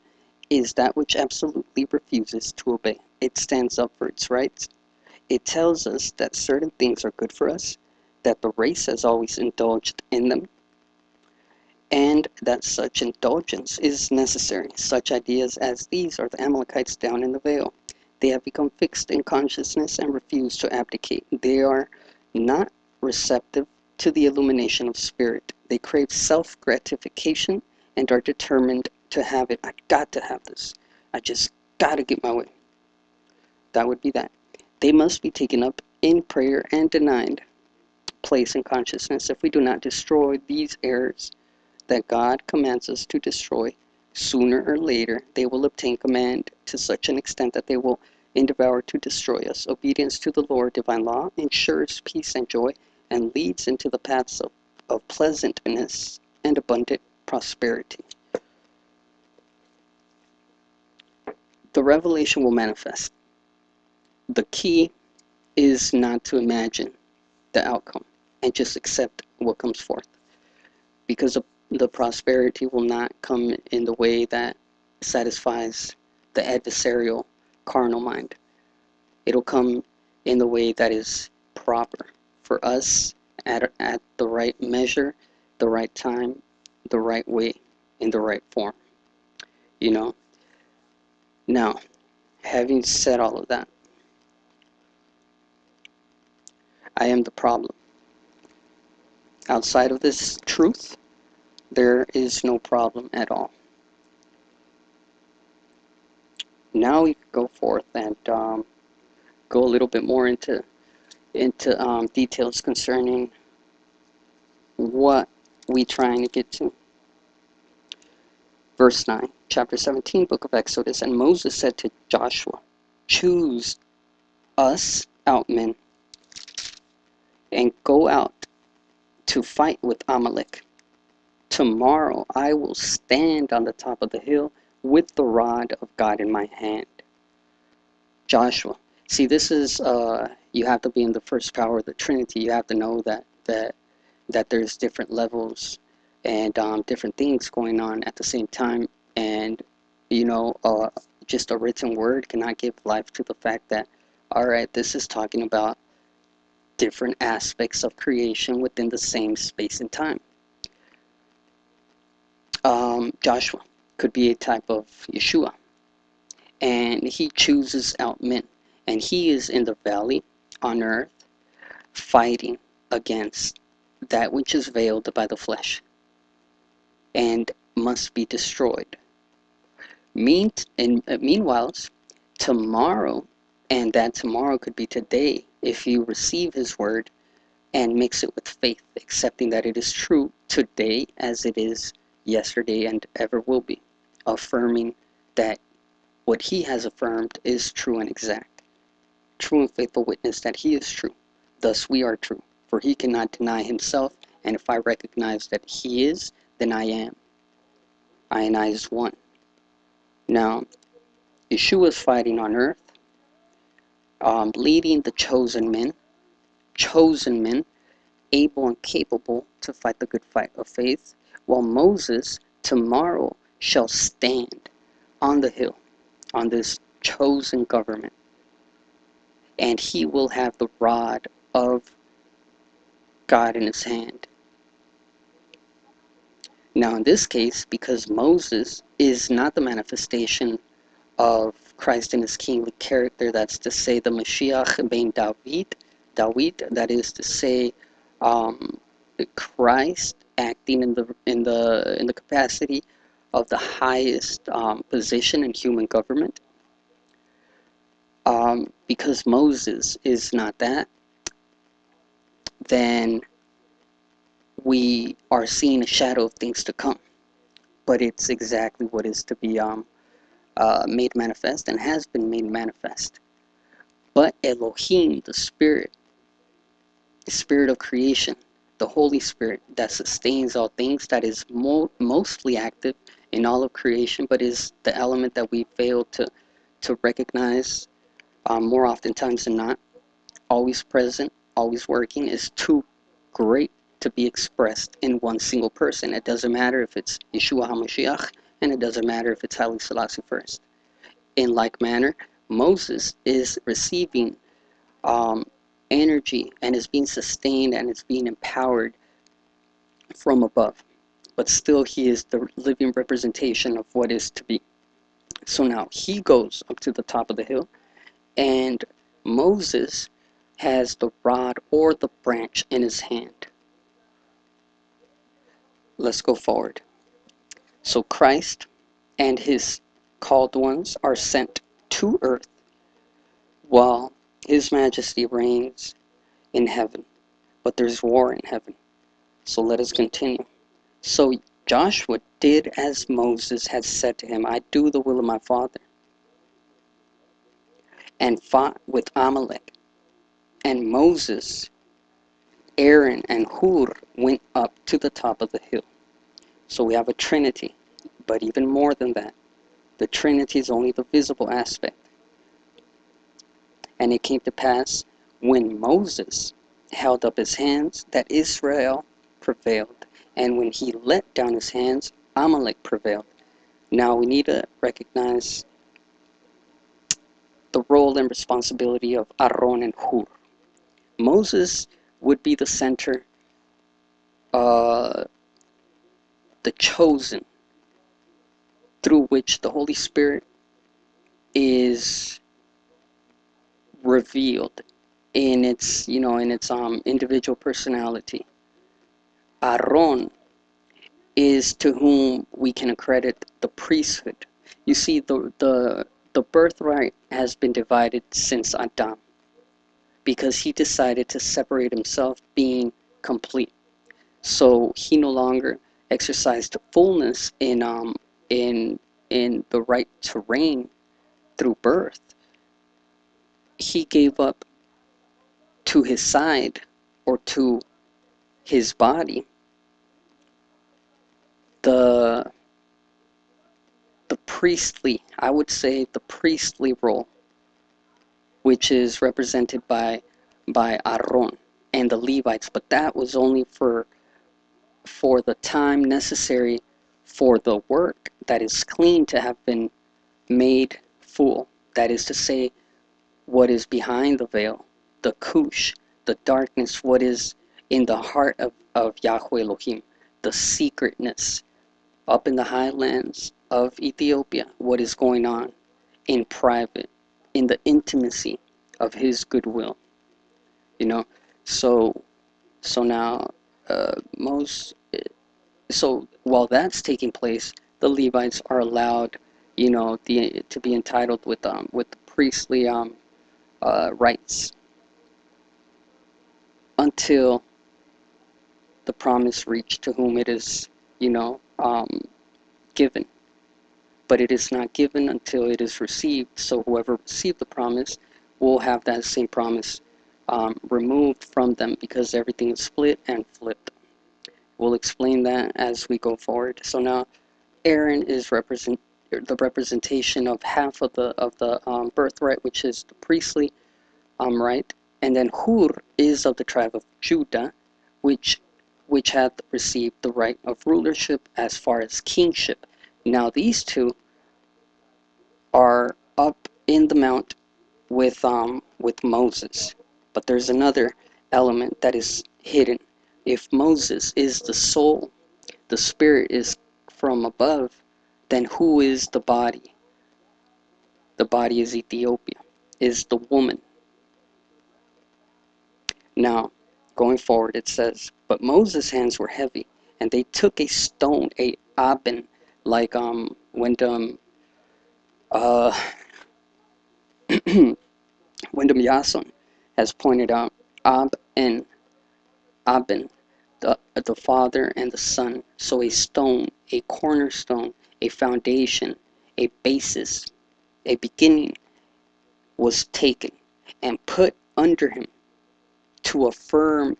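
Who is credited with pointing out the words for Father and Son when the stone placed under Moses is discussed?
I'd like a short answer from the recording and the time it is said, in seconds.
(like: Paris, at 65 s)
Wyndham Yason, at 558 s.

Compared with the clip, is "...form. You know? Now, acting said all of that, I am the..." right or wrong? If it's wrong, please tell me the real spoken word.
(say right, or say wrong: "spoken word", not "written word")
wrong: "having", not "acting".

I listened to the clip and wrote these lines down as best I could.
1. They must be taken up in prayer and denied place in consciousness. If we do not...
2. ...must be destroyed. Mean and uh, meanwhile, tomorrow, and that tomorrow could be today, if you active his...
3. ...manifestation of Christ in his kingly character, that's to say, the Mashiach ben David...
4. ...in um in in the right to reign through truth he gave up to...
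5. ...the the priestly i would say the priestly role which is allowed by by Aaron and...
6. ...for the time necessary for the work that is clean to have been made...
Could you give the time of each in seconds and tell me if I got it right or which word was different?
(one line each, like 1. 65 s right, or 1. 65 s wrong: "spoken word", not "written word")
1. 34 s right
2. 177 s wrong: "receive", not "active"
3. 239 s right
4. 417 s wrong: "birth", not "truth"
5. 431 s wrong: "represented", not "allowed"
6. 445 s right.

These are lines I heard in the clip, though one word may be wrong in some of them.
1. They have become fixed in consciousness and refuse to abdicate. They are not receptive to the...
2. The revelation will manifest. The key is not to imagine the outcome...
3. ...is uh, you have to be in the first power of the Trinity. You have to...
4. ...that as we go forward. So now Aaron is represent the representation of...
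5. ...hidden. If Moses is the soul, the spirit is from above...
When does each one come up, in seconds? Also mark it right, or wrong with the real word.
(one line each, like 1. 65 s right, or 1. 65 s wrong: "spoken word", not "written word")
1. 18 s right
2. 61 s right
3. 139 s right
4. 505 s right
5. 532 s right.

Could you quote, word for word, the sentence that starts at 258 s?
Um, because Moses is not that, then we are seeing a shadow of things to come.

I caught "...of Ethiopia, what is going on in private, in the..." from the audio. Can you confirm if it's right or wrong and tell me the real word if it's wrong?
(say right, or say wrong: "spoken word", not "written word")
right.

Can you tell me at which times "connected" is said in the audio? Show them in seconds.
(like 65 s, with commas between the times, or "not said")
not said.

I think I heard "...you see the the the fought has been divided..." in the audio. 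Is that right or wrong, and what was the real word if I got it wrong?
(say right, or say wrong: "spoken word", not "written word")
wrong: "birthright", not "fought".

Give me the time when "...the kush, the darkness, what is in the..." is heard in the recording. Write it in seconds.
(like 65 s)
455 s.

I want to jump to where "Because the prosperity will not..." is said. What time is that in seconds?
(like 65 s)
71 s.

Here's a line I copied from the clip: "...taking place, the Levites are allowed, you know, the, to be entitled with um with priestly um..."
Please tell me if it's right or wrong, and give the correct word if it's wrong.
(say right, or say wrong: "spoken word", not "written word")
right.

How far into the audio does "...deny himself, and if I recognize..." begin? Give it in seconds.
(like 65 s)
203 s.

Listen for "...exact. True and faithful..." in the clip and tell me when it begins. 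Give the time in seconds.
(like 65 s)
198 s.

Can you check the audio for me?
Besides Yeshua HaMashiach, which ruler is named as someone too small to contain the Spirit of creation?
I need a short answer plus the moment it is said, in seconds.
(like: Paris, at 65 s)
Haile Selassie first, at 299 s.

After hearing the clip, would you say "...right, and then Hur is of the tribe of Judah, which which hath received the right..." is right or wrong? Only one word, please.
right.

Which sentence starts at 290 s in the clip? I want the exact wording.
Always present, always working is too great to be expressed in one single person.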